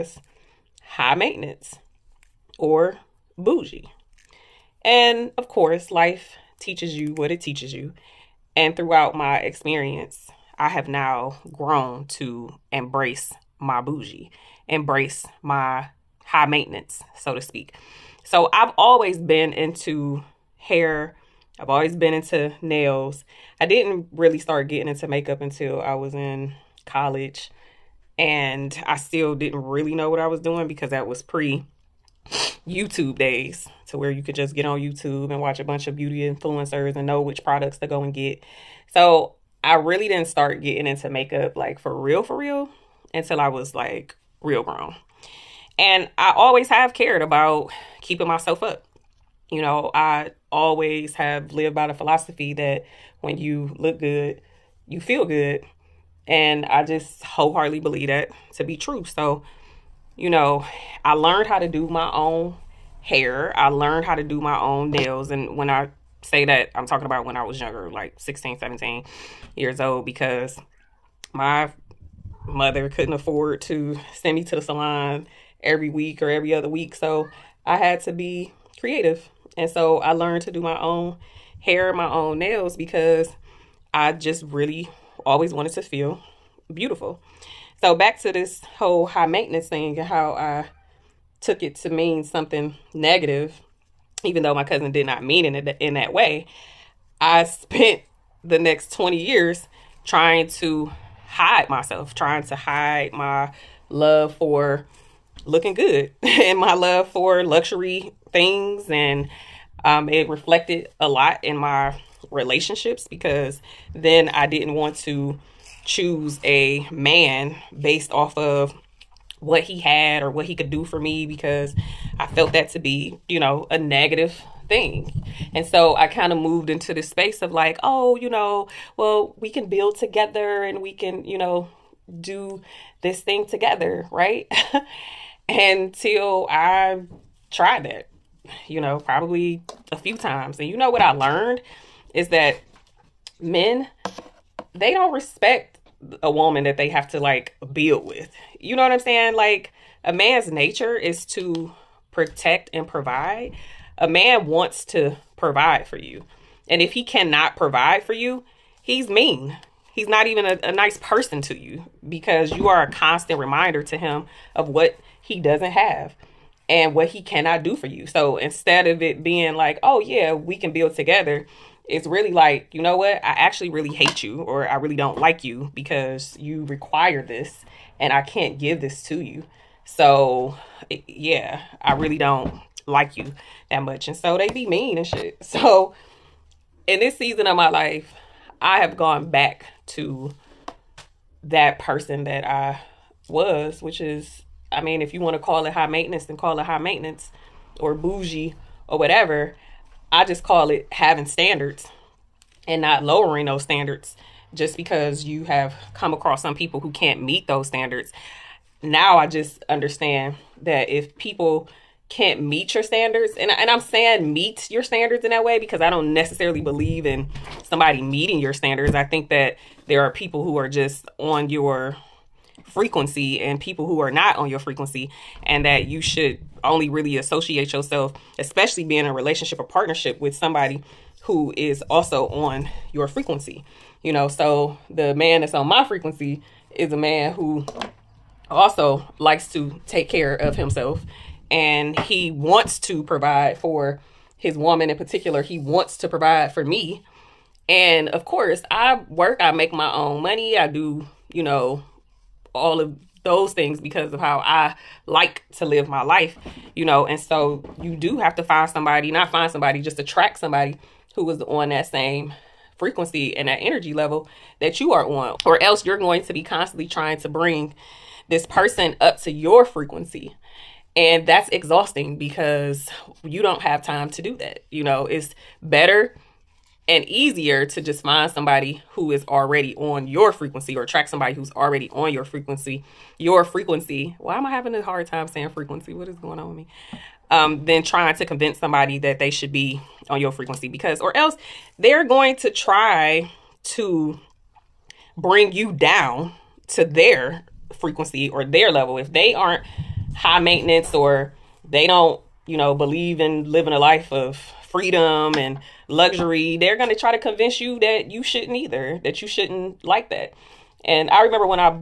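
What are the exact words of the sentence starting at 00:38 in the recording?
So I really didn't start getting into makeup like for real, for real until I was like real grown.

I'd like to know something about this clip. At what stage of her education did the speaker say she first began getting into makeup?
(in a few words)
college.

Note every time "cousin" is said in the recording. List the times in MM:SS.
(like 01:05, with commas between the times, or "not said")
01:34.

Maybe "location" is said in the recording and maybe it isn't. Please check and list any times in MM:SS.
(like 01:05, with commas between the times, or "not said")
not said.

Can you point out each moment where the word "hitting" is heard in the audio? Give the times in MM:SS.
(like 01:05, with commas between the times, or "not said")
not said.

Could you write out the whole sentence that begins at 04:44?
Why am I having a hard time saying frequency?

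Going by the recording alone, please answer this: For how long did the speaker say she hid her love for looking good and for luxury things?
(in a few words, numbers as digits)
20 years.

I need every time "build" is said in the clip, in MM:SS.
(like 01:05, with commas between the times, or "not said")
02:09, 02:27, 02:50.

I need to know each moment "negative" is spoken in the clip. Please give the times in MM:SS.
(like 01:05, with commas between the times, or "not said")
01:32, 02:03.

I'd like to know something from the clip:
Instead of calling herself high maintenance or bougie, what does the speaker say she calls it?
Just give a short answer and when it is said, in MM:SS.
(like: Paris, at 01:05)
having standards, at 03:20.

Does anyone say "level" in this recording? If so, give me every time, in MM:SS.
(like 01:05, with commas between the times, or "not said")
04:23, 04:58.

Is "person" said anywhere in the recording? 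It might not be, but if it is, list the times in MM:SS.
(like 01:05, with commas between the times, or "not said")
02:40, 03:11, 04:28.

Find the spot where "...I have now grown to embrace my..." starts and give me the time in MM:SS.
00:10.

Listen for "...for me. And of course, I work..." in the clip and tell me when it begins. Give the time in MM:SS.
04:06.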